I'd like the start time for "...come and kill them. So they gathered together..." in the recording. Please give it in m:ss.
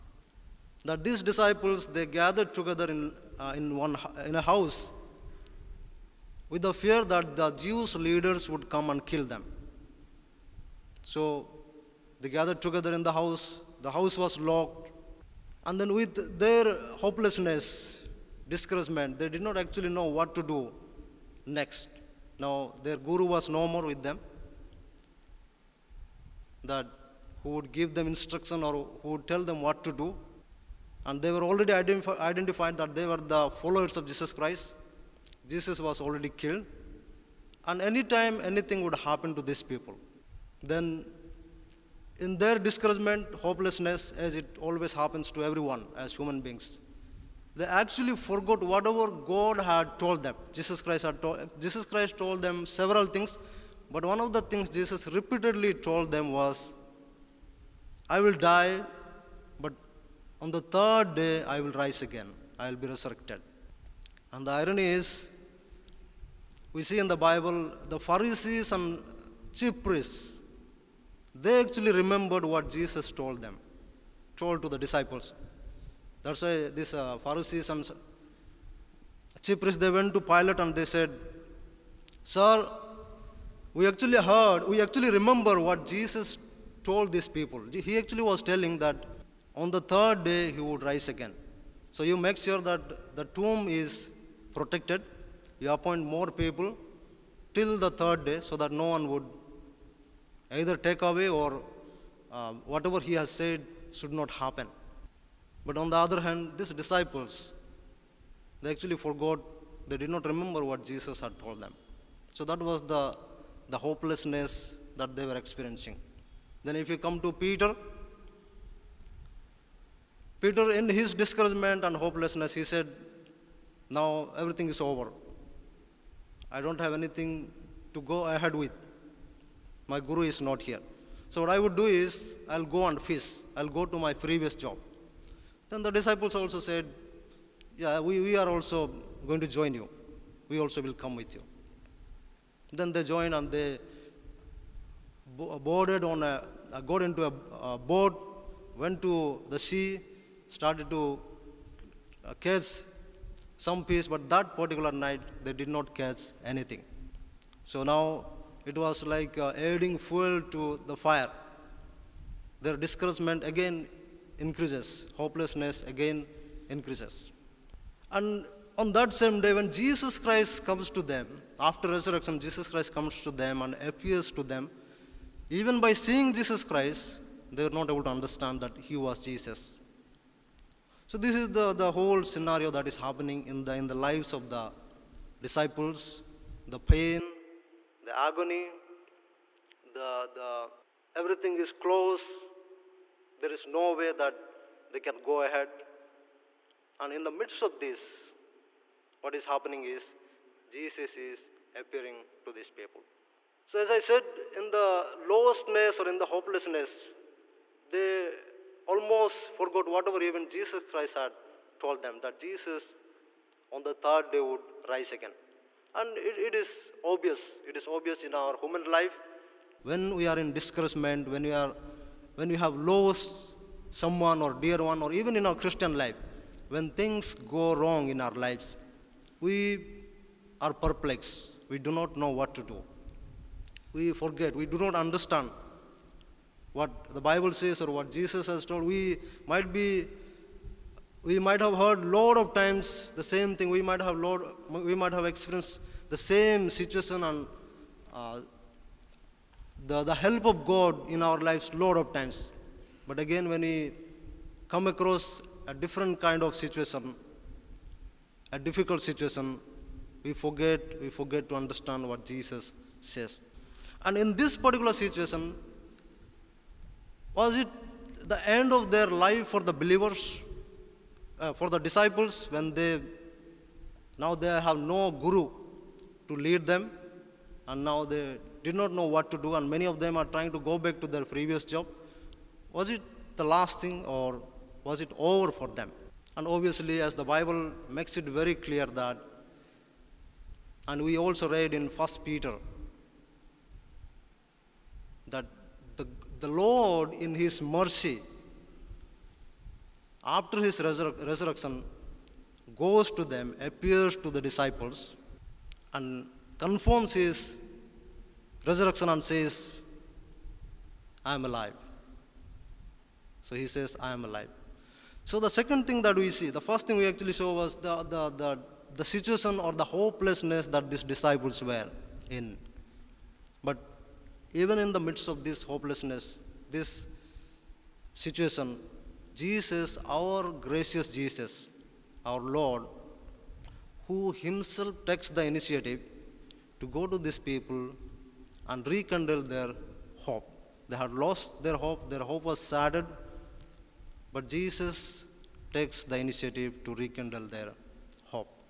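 0:08.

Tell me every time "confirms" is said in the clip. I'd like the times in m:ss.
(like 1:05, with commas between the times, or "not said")
5:06.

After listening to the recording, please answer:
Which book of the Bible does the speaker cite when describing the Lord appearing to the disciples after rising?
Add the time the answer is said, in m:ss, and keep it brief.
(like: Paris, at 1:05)
First Peter, at 4:51.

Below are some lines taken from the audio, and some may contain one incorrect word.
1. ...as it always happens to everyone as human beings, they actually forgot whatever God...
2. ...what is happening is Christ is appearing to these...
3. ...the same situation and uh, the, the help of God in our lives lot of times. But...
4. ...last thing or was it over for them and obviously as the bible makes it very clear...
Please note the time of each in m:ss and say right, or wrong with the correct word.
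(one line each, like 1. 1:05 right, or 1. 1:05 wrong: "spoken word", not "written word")
1. 0:44 right
2. 3:19 wrong: "Jesus", not "Christ"
3. 4:06 right
4. 4:43 right.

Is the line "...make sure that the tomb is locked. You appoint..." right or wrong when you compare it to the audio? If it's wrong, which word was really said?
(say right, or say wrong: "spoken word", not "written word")
wrong: "protected", not "locked".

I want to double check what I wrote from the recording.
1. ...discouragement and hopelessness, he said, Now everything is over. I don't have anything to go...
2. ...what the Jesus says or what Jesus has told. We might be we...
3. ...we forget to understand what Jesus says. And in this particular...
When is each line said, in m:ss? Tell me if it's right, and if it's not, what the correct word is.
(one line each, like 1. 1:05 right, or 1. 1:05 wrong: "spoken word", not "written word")
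1. 2:01 right
2. 3:56 wrong: "Bible", not "Jesus"
3. 4:21 right.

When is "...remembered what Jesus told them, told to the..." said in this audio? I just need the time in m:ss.
1:12.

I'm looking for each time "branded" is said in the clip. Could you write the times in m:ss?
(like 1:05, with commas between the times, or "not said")
not said.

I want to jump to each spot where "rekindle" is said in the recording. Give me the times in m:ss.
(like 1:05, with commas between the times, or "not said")
5:38, 5:47.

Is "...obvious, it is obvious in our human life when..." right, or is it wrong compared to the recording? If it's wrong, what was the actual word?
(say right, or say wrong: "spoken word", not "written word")
right.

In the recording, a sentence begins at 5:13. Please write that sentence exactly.
So he says, I am alive.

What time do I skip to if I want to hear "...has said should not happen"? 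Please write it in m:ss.
1:43.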